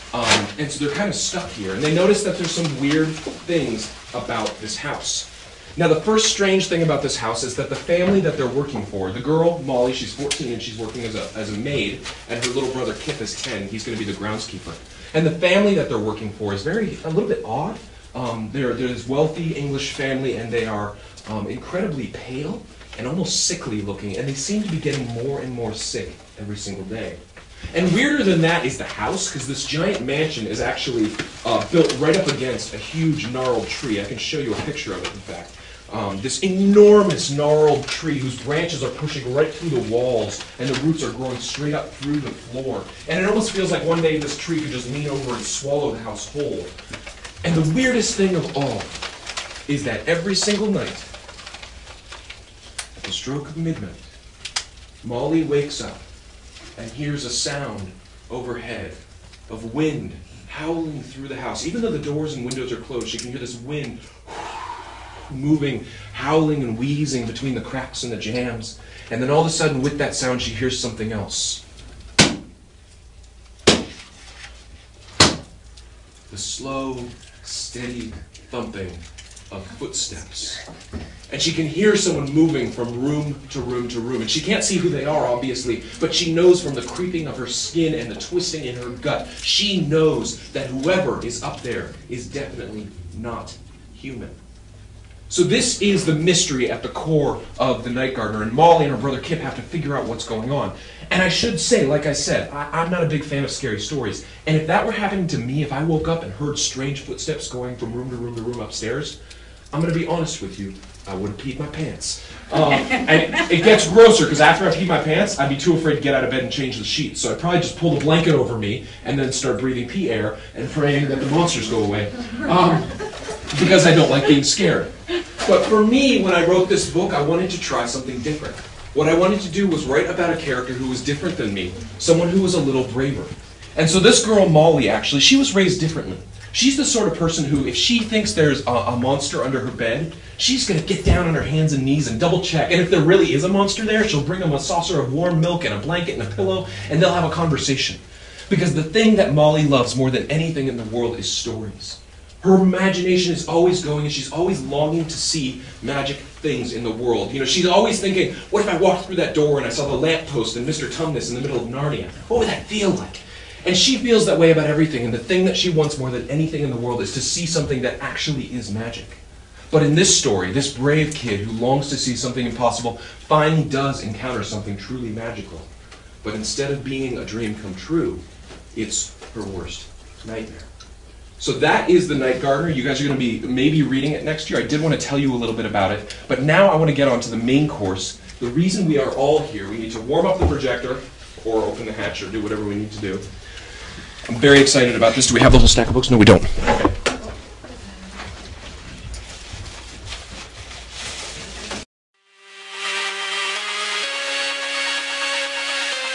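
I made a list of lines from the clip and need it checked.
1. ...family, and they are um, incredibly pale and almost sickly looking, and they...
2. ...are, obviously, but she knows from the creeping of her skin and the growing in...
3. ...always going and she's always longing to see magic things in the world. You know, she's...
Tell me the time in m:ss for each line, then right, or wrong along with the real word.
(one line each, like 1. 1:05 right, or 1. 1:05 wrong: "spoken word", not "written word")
1. 0:19 right
2. 1:25 wrong: "twisting", not "growing"
3. 2:33 right.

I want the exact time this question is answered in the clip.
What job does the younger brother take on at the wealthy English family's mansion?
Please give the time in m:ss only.
0:14.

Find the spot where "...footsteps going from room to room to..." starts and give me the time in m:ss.
1:47.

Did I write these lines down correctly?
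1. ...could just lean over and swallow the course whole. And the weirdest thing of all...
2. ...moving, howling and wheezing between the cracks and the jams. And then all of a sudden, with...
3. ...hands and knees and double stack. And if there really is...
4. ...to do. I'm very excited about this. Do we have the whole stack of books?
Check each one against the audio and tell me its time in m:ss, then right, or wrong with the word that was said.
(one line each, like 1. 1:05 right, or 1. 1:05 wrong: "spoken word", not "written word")
1. 0:44 wrong: "house", not "course"
2. 1:05 right
3. 2:21 wrong: "check", not "stack"
4. 3:12 right.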